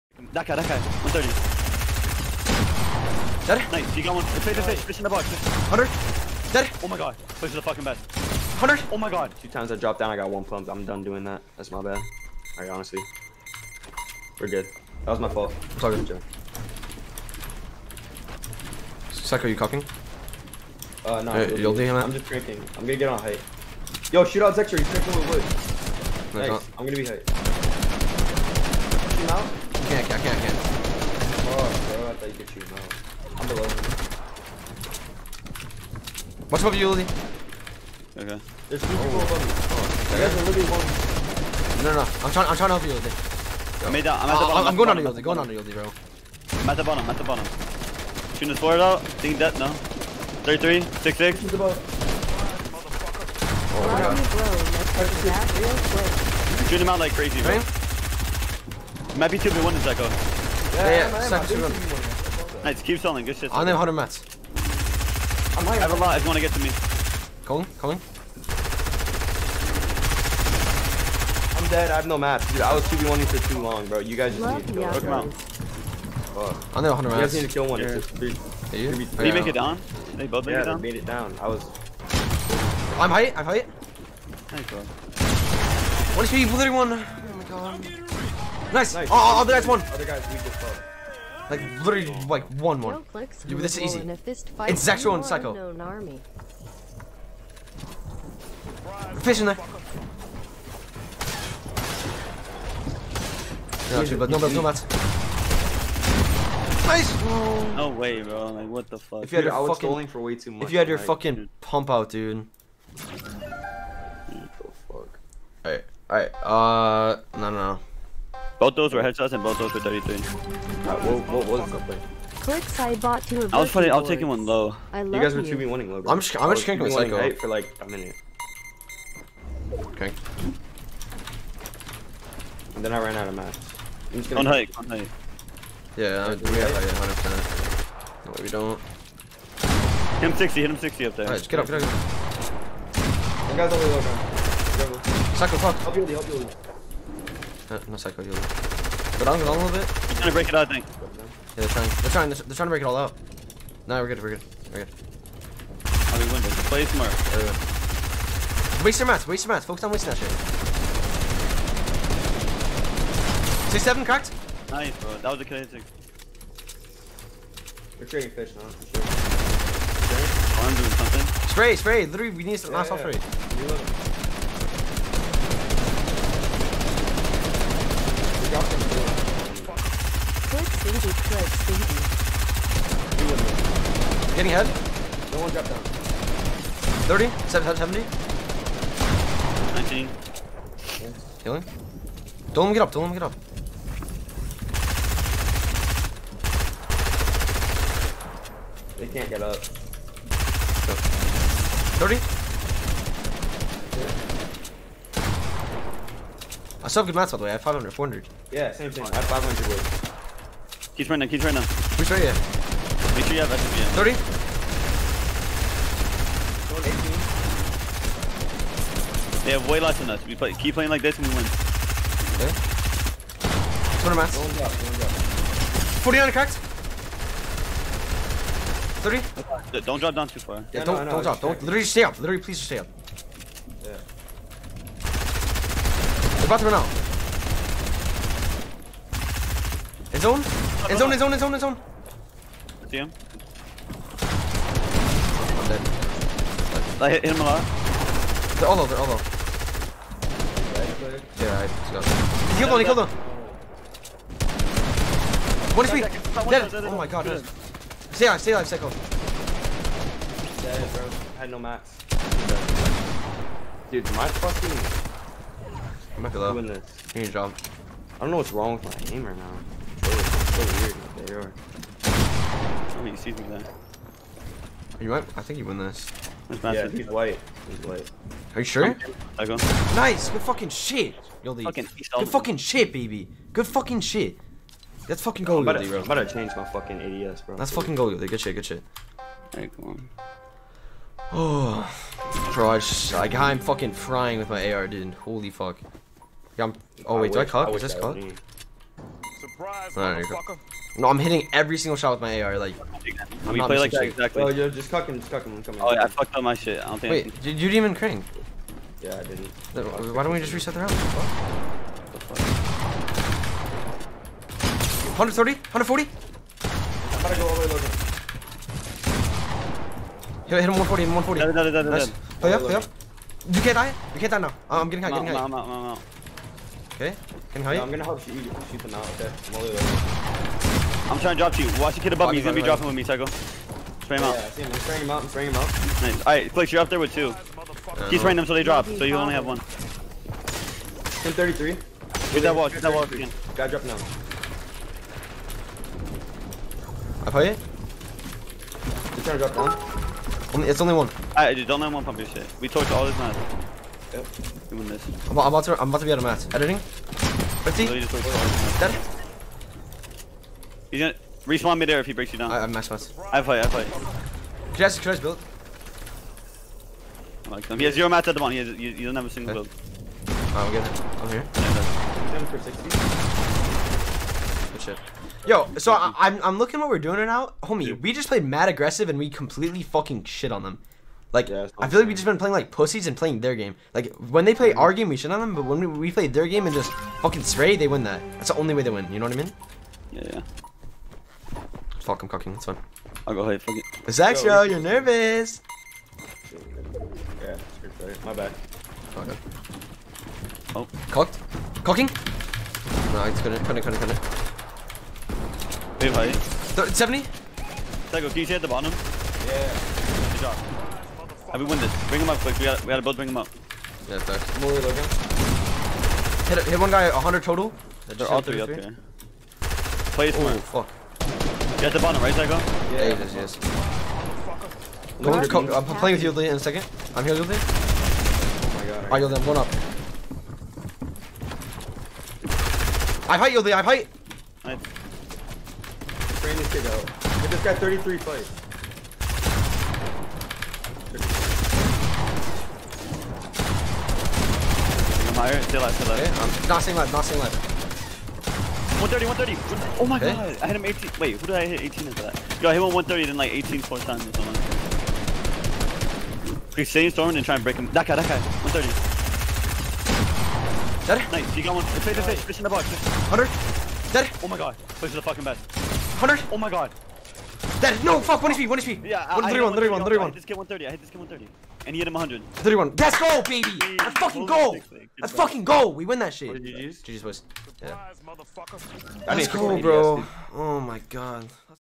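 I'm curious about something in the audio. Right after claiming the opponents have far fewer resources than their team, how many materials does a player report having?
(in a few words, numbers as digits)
200.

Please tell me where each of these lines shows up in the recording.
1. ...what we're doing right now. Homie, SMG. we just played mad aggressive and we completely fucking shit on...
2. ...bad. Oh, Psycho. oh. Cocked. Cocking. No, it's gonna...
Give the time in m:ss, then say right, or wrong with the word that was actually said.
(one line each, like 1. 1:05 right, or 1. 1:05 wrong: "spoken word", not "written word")
1. 6:16 wrong: "Dude", not "SMG"
2. 6:38 wrong: "God", not "Psycho".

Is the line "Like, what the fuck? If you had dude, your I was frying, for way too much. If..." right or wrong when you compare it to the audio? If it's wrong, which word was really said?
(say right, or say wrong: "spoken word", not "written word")
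wrong: "fucking", not "frying".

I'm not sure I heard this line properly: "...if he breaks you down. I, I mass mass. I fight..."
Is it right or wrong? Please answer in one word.
right.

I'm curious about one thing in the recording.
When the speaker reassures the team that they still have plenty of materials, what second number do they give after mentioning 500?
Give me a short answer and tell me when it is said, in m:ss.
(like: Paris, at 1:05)
400, at 3:27.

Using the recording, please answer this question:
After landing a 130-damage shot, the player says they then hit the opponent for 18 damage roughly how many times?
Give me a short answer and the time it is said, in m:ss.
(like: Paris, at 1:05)
4 times, at 7:33.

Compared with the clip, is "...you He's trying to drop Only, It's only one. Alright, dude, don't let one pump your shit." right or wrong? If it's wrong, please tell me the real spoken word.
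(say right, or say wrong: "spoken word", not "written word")
right.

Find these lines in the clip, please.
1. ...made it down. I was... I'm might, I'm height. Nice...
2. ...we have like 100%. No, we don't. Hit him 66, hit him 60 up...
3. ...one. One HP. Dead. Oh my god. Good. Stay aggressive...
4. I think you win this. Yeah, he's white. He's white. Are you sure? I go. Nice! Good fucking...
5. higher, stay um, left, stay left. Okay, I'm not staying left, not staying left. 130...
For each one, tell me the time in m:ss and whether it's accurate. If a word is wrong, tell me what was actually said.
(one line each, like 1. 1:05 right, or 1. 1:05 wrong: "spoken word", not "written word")
1. 1:20 wrong: "height", not "might"
2. 2:16 wrong: "60", not "66"
3. 4:12 wrong: "alive", not "aggressive"
4. 4:35 right
5. 7:25 right.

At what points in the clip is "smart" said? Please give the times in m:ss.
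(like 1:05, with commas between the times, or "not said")
2:36, 7:00.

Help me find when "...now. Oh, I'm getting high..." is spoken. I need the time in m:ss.
5:24.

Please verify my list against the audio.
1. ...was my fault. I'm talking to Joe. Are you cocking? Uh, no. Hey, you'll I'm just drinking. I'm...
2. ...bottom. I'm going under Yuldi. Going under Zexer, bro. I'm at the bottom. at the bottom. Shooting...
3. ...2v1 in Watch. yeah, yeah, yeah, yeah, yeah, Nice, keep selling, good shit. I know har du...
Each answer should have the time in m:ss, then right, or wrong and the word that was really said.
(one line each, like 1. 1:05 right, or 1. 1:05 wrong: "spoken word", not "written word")
1. 0:15 right
2. 0:44 wrong: "Yuldi", not "Zexer"
3. 0:59 wrong: "Zekko", not "Watch".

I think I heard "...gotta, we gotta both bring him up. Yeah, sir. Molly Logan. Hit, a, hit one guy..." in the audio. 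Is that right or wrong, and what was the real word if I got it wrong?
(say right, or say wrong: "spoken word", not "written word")
right.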